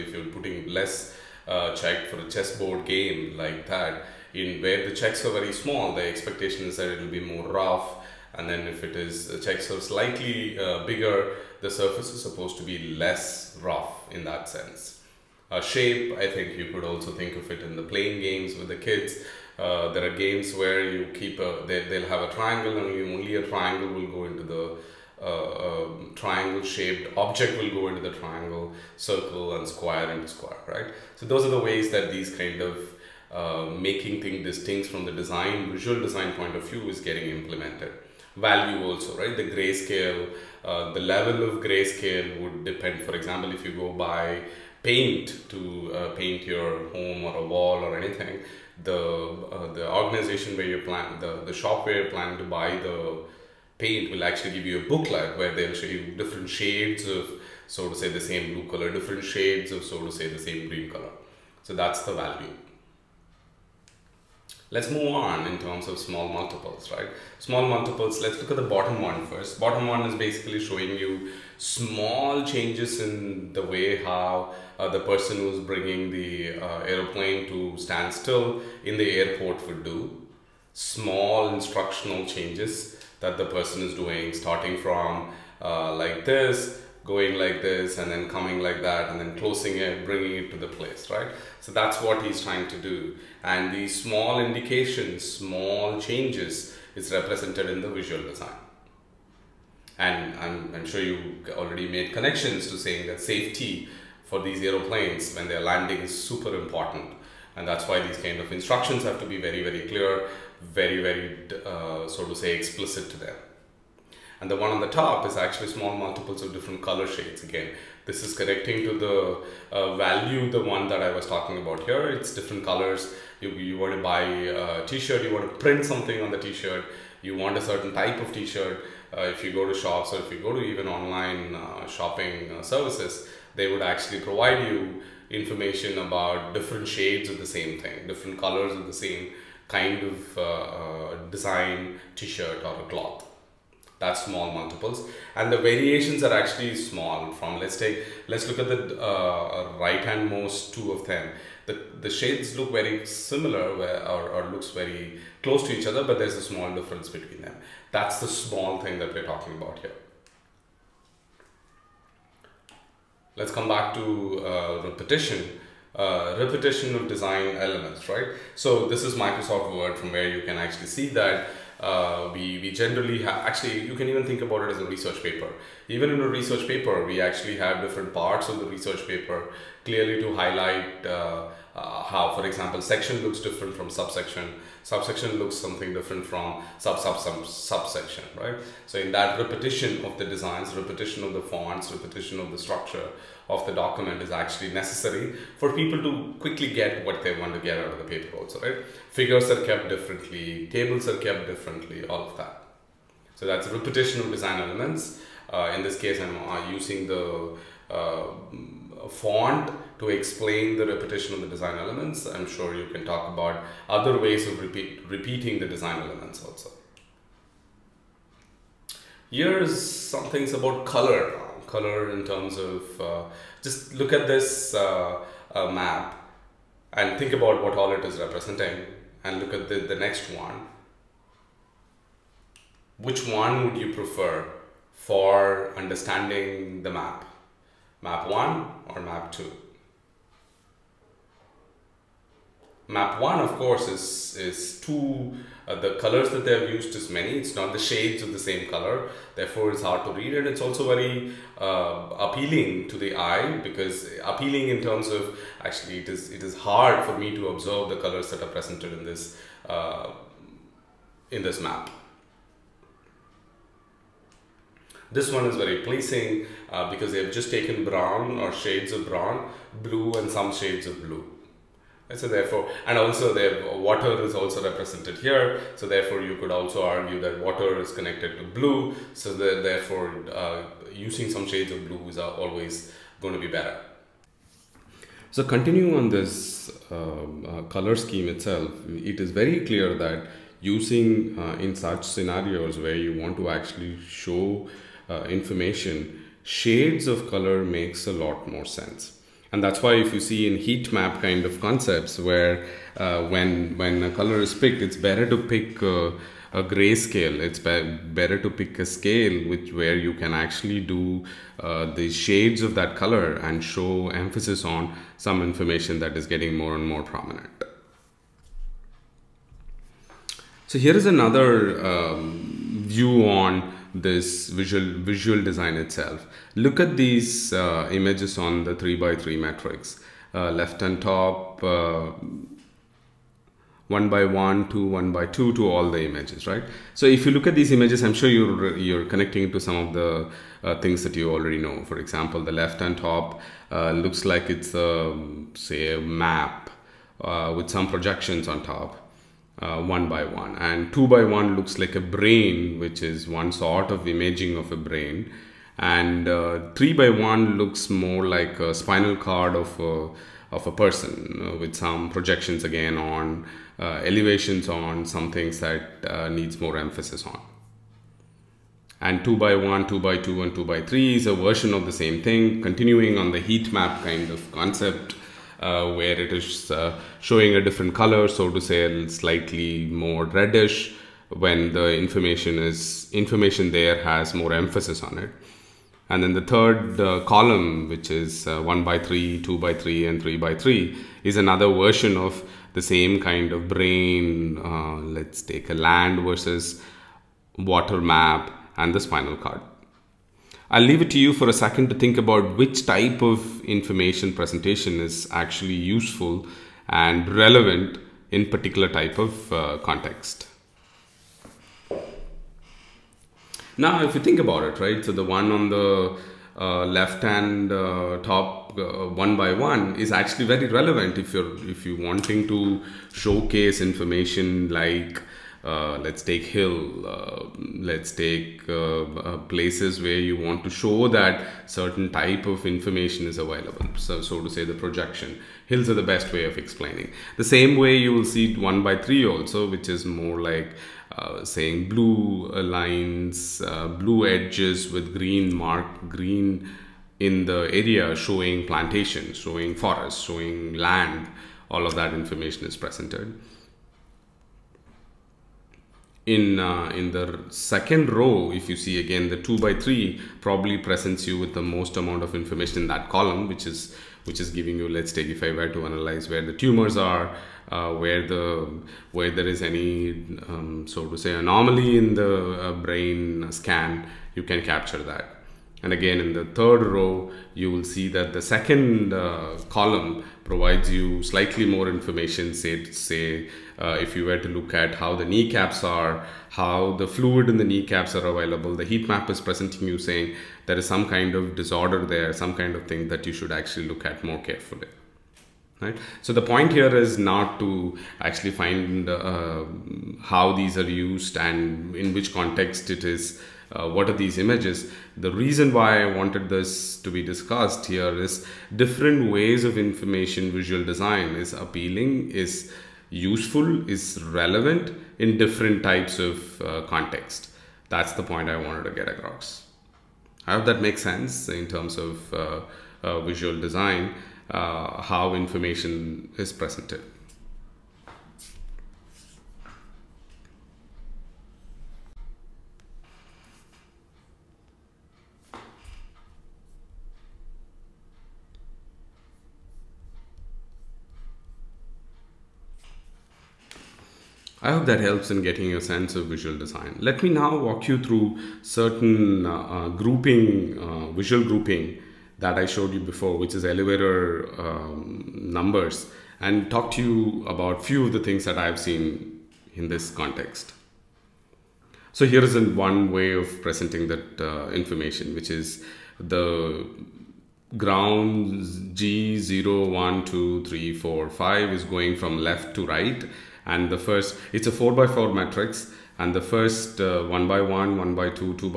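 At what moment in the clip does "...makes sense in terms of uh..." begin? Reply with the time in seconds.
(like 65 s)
520 s.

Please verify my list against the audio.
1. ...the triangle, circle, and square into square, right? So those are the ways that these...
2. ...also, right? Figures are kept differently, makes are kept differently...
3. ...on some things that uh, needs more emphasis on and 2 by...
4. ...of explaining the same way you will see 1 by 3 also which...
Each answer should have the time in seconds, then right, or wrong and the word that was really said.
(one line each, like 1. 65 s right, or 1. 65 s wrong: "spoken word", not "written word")
1. 27 s right
2. 198 s wrong: "tables", not "makes"
3. 364 s right
4. 436 s right.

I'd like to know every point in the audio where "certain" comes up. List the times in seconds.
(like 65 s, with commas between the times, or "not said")
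127 s, 431 s, 548 s.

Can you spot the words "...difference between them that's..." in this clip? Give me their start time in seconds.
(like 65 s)
156 s.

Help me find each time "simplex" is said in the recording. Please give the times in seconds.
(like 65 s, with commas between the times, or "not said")
not said.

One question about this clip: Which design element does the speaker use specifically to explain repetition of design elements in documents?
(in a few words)
Font.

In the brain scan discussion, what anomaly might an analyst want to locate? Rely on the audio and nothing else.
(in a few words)
Tumors.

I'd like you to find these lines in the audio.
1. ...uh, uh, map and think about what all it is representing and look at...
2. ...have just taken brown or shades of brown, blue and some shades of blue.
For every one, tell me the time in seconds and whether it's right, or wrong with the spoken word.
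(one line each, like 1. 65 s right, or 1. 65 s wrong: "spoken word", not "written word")
1. 224 s right
2. 267 s right.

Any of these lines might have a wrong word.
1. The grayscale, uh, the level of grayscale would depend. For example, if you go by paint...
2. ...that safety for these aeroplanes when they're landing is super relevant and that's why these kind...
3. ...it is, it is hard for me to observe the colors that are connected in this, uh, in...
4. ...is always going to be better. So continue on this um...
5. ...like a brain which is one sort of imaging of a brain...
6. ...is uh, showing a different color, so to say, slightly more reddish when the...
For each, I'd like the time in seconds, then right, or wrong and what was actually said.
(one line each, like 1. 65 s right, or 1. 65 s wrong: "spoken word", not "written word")
1. 39 s right
2. 103 s wrong: "important", not "relevant"
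3. 255 s wrong: "presented", not "connected"
4. 282 s right
5. 351 s right
6. 376 s right.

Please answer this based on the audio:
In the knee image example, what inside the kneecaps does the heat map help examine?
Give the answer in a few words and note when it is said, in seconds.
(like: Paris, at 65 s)
The fluid, at 487 s.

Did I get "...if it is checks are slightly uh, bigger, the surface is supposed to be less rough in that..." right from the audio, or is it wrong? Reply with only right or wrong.
right.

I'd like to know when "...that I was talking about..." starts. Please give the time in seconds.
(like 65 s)
120 s.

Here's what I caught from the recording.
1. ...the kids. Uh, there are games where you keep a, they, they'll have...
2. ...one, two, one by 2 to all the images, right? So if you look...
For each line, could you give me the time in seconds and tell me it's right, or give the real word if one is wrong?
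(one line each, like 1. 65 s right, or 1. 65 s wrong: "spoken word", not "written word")
1. 18 s right
2. 334 s right.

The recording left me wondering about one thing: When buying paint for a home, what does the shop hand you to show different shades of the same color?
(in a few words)
A booklet.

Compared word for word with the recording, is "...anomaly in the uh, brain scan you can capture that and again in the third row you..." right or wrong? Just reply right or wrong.
right.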